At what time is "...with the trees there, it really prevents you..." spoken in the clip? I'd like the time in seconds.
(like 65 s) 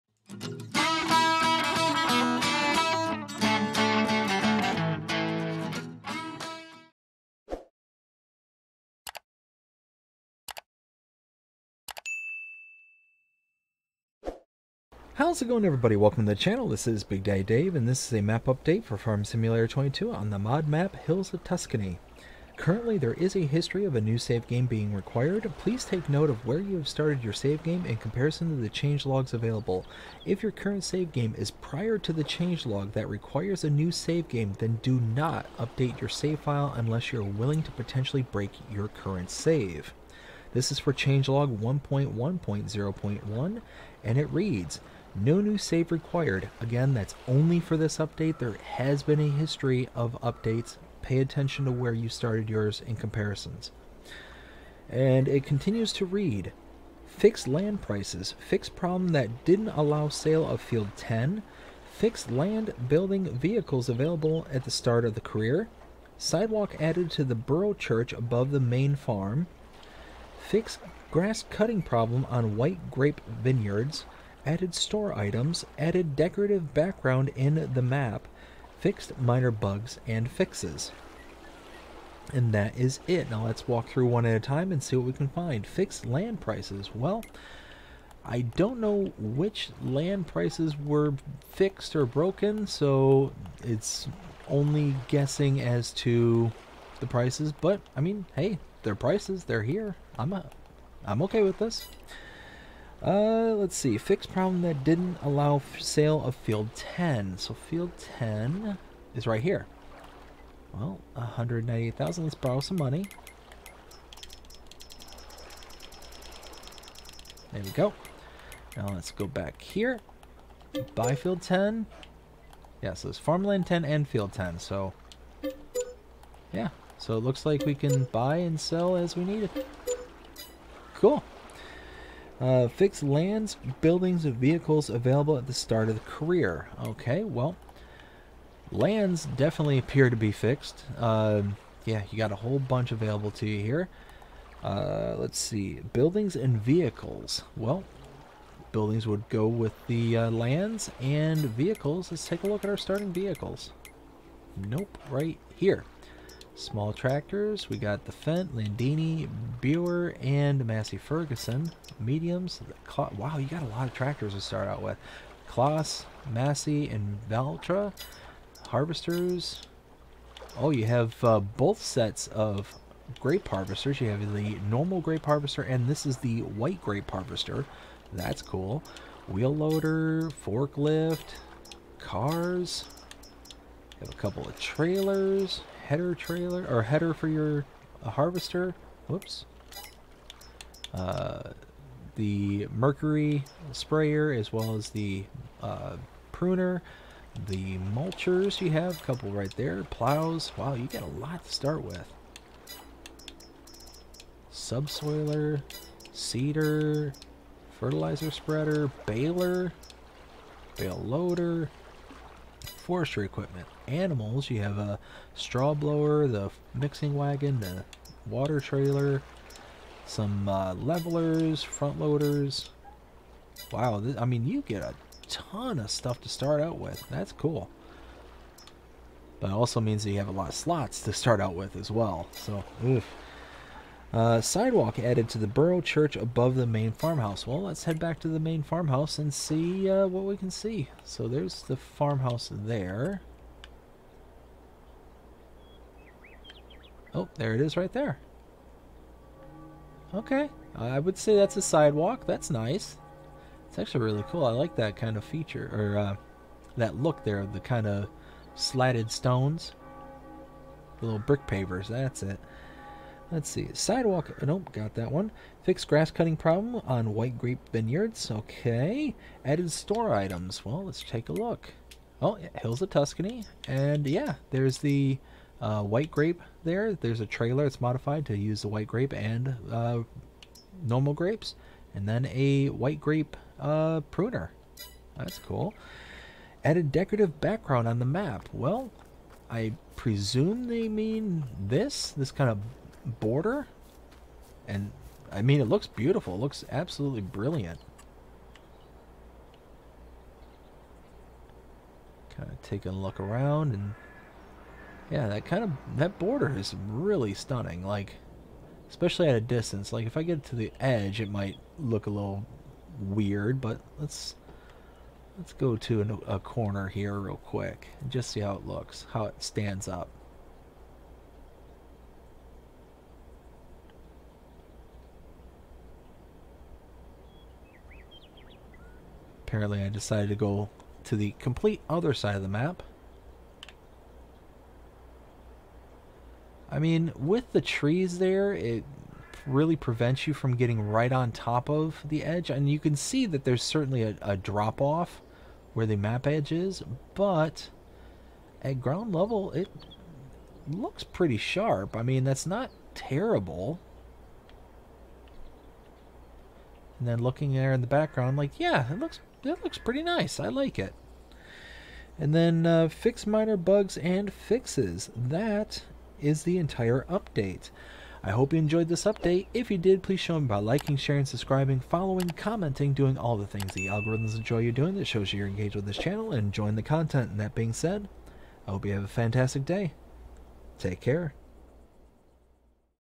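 337 s.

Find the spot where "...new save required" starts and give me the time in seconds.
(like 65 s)
45 s.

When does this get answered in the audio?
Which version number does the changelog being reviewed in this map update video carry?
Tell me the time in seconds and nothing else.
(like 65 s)
41 s.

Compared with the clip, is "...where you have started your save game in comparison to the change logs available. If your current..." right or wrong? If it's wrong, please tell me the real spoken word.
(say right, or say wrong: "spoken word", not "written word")
right.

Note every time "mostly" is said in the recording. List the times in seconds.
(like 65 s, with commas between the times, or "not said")
not said.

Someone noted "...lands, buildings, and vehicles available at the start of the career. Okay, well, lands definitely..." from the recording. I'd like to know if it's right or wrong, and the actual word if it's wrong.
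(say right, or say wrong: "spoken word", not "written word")
right.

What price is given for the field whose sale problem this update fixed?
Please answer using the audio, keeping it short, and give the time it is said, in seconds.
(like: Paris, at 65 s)
198,000, at 111 s.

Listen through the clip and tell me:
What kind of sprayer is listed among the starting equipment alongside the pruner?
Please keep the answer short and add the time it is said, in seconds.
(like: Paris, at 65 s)
mercury sprayer, at 192 s.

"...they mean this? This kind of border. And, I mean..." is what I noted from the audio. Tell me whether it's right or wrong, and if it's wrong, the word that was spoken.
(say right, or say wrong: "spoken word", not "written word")
right.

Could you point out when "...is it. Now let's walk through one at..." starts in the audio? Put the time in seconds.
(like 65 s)
82 s.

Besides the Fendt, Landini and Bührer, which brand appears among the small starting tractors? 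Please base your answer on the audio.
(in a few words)
Massey Ferguson.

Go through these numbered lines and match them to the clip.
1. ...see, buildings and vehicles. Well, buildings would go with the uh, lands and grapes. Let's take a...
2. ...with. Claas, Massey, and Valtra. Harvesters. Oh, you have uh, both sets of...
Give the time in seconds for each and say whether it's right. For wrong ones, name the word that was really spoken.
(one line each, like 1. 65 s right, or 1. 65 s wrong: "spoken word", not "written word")
1. 145 s wrong: "vehicles", not "grapes"
2. 164 s right.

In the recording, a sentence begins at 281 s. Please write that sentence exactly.
And then a white grape uh, pruner.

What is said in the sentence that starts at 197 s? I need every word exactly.
The mulchers you have, a couple right there.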